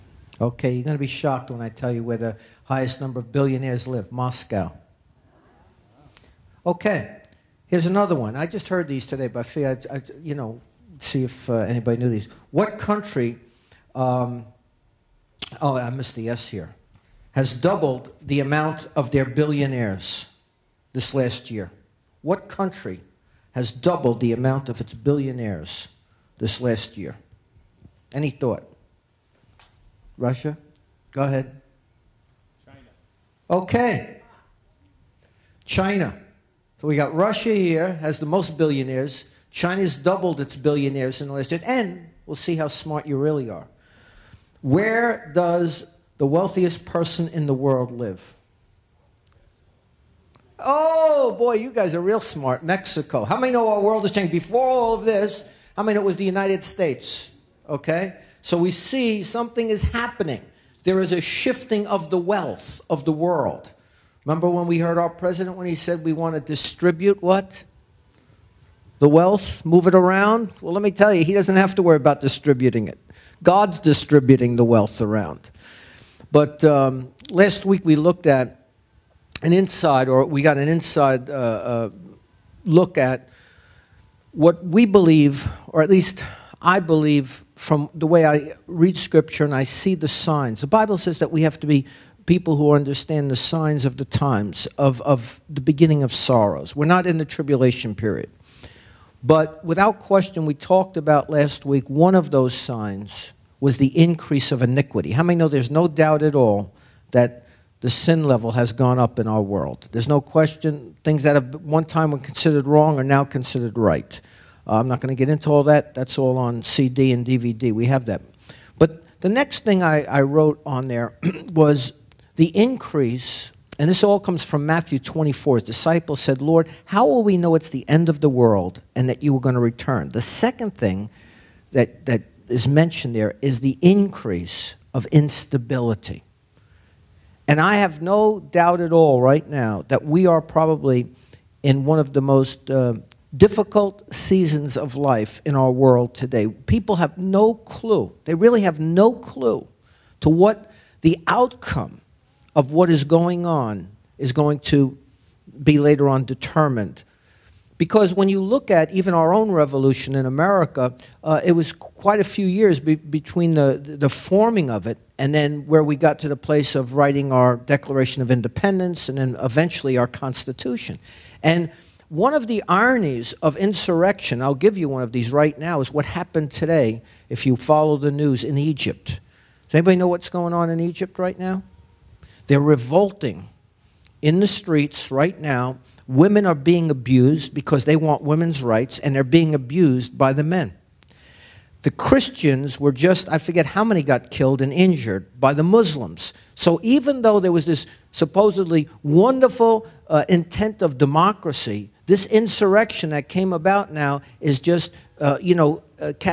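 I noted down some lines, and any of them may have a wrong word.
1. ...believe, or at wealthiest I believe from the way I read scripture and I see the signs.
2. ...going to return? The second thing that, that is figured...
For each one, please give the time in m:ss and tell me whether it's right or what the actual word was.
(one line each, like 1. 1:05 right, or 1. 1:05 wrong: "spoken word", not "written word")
1. 1:24 wrong: "least", not "wealthiest"
2. 2:09 wrong: "mentioned", not "figured".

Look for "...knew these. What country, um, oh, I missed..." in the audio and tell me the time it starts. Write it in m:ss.
0:12.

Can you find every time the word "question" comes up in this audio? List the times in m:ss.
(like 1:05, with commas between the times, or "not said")
1:39, 1:50.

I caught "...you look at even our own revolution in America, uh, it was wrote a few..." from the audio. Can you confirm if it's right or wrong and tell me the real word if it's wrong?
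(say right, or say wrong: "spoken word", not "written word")
wrong: "quite", not "wrote".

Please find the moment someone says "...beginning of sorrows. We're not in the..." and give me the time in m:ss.
1:35.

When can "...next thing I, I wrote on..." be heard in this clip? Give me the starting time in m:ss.
1:59.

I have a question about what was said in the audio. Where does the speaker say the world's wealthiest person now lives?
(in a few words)
Mexico.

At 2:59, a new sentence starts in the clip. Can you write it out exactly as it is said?
Does anybody know what's going on in Egypt right now?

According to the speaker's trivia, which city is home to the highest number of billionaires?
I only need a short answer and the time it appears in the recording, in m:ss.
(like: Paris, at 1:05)
Moscow, at 0:04.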